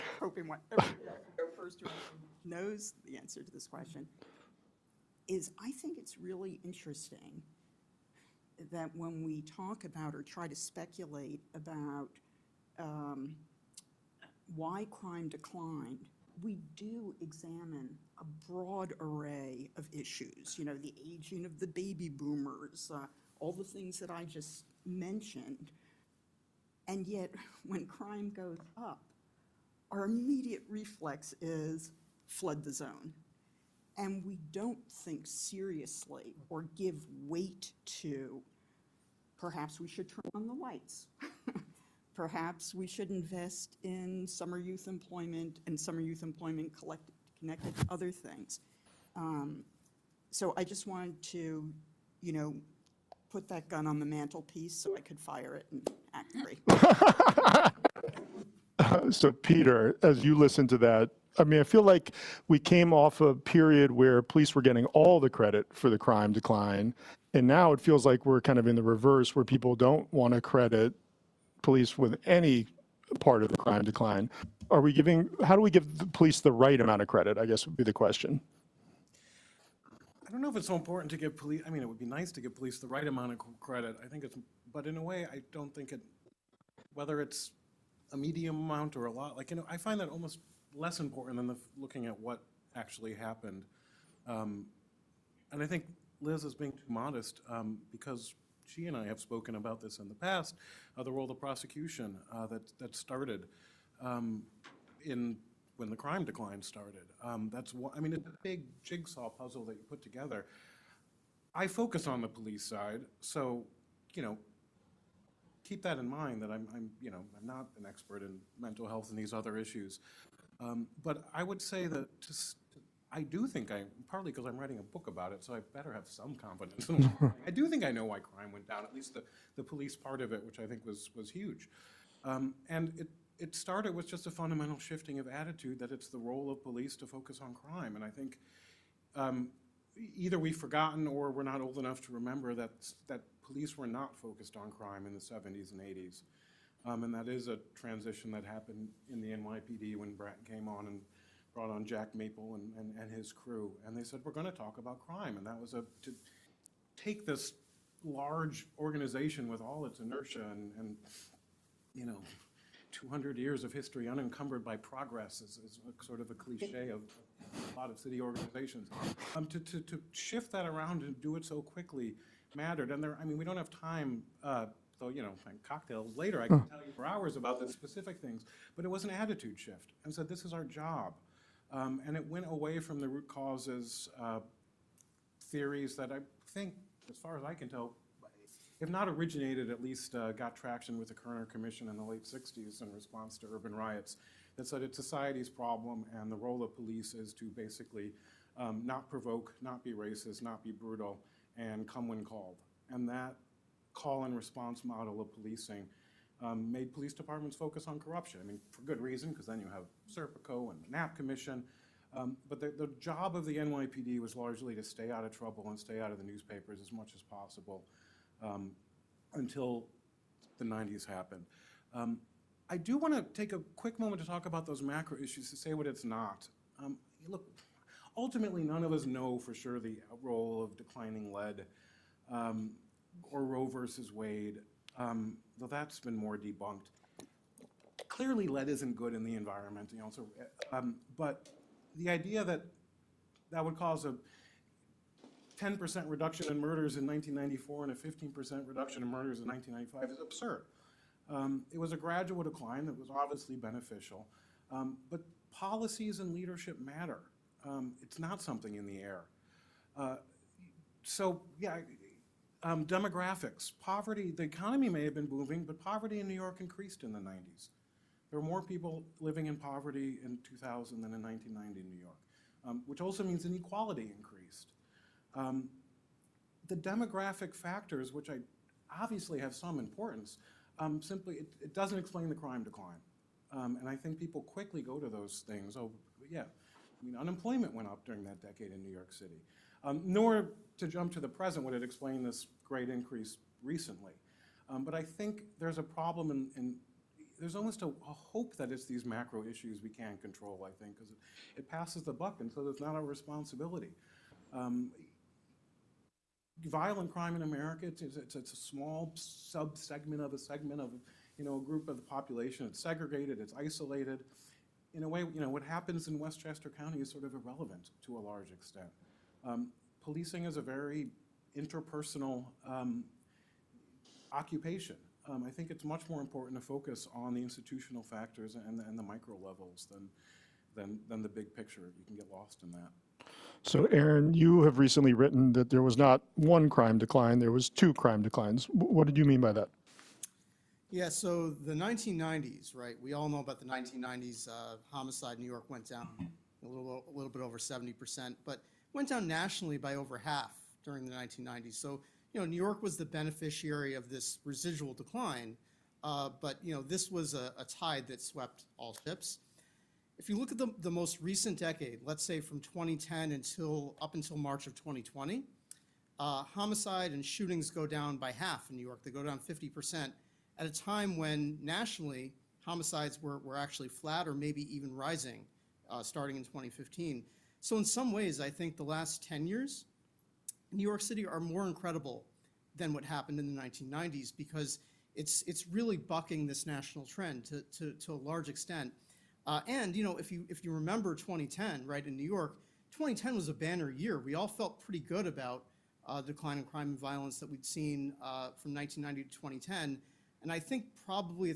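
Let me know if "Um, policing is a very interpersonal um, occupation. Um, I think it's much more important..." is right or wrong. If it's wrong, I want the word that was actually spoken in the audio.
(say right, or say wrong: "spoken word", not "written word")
right.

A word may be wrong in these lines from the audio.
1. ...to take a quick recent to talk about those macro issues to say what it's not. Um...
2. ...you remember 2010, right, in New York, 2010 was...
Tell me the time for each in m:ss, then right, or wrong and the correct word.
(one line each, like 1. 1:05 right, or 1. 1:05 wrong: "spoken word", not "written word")
1. 3:43 wrong: "moment", not "recent"
2. 6:30 right.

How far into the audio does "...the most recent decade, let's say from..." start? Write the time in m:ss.
6:00.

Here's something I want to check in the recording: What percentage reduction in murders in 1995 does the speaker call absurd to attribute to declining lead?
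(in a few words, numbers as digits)
15%.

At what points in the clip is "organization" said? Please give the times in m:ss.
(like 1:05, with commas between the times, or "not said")
2:38, 2:48.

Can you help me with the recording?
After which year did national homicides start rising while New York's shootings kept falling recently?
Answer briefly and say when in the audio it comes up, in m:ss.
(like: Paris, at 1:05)
2015, at 6:16.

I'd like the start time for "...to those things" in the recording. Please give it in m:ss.
4:44.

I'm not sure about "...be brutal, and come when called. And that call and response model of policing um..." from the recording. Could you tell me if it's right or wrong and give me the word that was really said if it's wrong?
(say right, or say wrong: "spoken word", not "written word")
right.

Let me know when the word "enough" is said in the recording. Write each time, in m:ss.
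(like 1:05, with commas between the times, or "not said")
2:21.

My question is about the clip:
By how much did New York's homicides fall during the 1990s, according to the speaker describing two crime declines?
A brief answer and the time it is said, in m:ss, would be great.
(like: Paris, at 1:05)
a little over 70%, at 5:47.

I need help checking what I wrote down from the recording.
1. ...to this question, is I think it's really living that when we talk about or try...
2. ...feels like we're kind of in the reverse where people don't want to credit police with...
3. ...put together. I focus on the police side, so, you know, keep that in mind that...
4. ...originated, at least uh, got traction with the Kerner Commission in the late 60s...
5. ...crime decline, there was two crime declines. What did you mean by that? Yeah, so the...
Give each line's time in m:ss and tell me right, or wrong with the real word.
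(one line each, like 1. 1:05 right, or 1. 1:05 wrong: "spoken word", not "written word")
1. 0:03 wrong: "interesting", not "living"
2. 1:07 right
3. 1:49 right
4. 3:09 right
5. 5:36 right.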